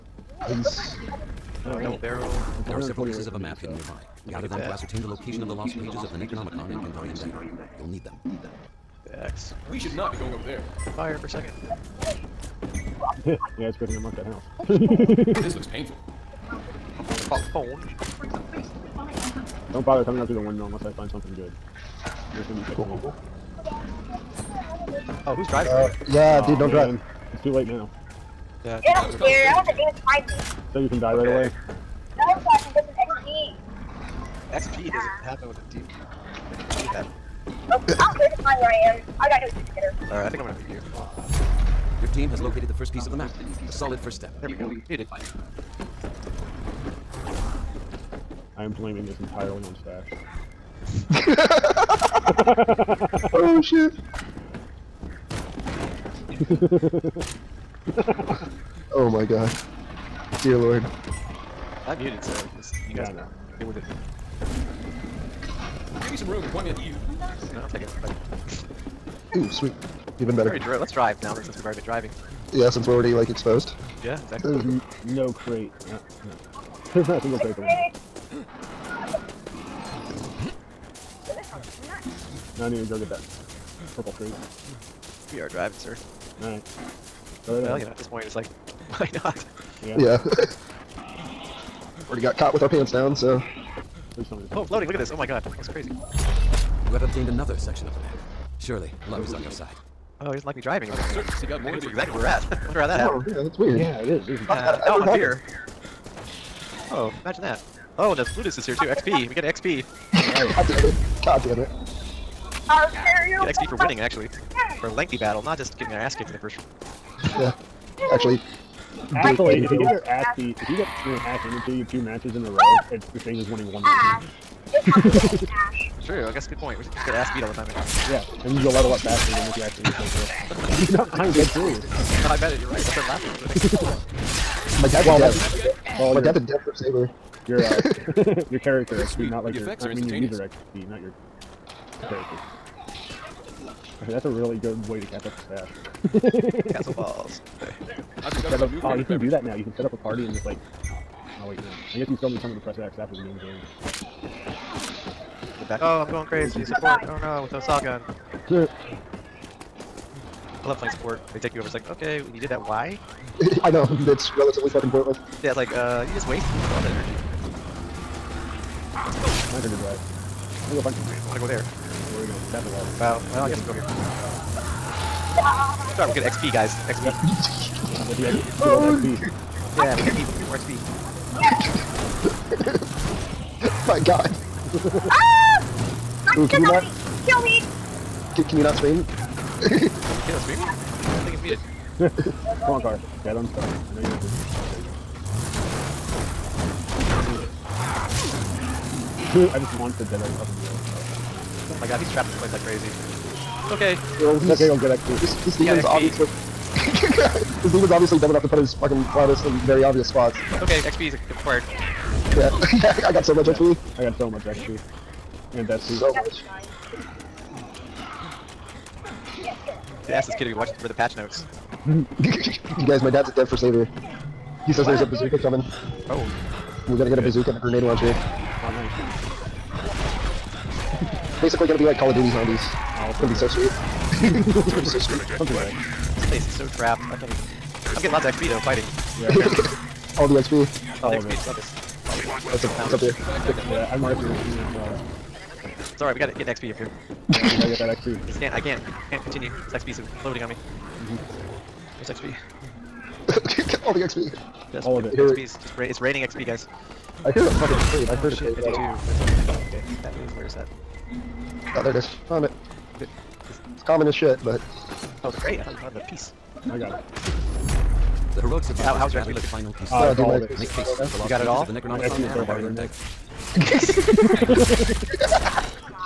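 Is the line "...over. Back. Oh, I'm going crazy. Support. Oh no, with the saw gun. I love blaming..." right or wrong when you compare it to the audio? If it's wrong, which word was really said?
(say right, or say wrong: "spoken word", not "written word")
wrong: "playing", not "blaming".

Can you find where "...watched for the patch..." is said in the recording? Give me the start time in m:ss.
3:40.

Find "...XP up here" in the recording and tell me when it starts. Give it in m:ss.
4:06.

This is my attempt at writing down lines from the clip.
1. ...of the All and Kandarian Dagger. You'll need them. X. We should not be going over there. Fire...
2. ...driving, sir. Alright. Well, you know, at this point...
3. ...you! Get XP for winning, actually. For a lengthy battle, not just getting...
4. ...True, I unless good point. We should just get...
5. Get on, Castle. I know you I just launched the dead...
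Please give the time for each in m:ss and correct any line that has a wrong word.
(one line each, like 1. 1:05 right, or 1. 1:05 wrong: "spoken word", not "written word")
1. 0:06 wrong: "Necronomicon", not "All"
2. 1:25 right
3. 1:53 right
4. 2:06 wrong: "guess", not "unless"
5. 3:13 wrong: "Carter", not "Castle".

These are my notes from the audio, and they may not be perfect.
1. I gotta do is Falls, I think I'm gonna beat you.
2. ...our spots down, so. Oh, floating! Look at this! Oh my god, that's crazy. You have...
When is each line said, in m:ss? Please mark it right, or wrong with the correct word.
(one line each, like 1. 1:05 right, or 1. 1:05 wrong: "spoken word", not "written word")
1. 0:39 wrong: "Alright", not "Falls"
2. 1:32 wrong: "pants", not "spots".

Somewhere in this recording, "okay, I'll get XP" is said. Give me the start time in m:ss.
3:24.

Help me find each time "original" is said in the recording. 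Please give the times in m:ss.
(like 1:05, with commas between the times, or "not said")
not said.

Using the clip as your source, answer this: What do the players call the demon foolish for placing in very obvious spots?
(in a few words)
Cloudus.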